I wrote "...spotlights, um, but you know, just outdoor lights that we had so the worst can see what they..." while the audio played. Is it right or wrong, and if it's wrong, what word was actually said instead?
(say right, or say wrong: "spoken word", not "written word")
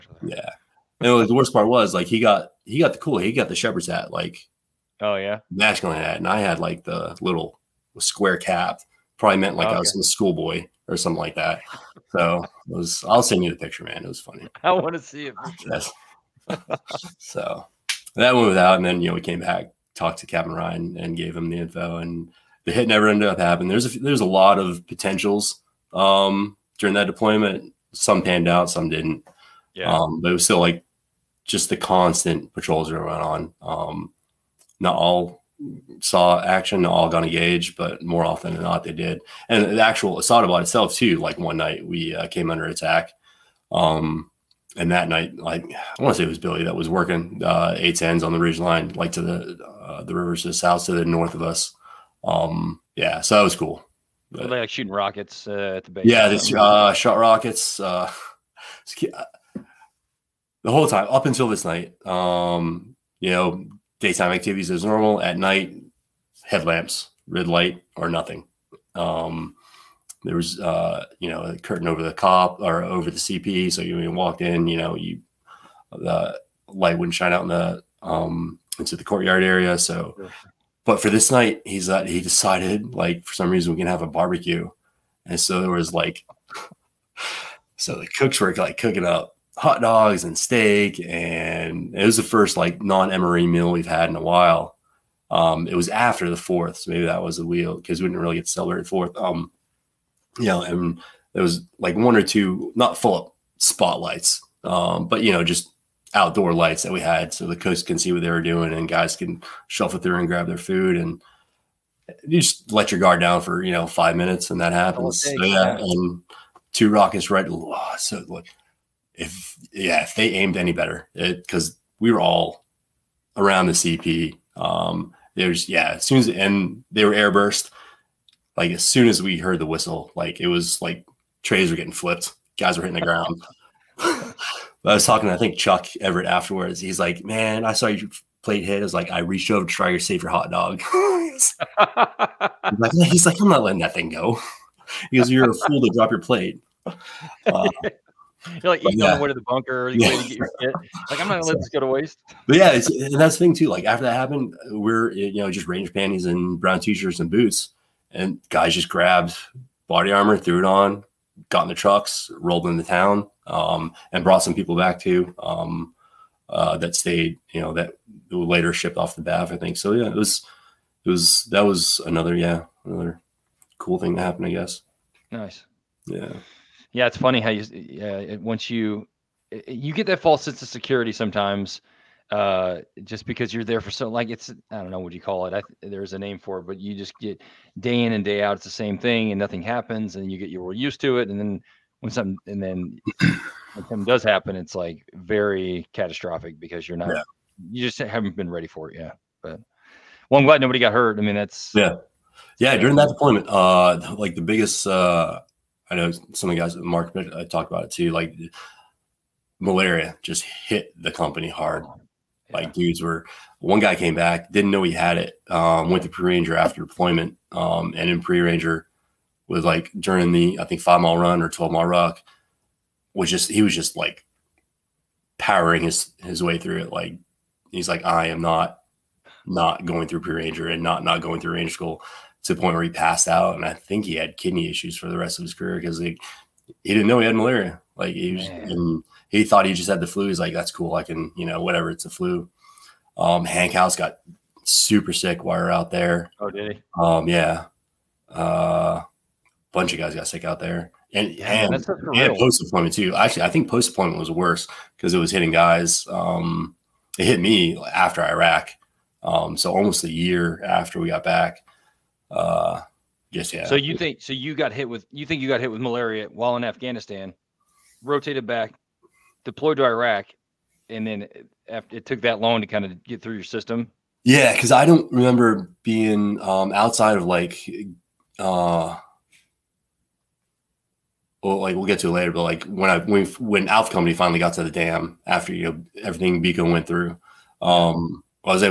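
wrong: "coast", not "worst".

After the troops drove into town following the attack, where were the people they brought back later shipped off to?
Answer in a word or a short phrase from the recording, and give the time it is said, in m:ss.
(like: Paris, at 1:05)
BAF, at 2:49.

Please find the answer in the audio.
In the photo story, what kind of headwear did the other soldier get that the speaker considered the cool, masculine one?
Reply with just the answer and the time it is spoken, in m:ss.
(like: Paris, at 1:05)
shepherd's hat, at 0:03.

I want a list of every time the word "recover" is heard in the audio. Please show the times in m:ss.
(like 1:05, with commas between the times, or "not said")
not said.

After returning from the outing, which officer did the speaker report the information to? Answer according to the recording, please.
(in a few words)
Captain Ryan.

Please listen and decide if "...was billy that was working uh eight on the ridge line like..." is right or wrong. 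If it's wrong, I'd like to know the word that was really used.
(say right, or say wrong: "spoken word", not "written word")
right.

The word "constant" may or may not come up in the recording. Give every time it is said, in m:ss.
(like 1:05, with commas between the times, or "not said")
0:31.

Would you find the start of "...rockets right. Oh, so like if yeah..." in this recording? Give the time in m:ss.
1:56.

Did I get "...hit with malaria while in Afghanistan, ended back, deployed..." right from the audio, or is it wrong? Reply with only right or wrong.
wrong.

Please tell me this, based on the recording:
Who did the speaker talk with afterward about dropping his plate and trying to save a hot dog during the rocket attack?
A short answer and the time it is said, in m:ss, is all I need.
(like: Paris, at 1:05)
Chuck Everett, at 2:15.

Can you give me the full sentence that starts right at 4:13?
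Actually, I think post deployment was worse because it was hitting guys.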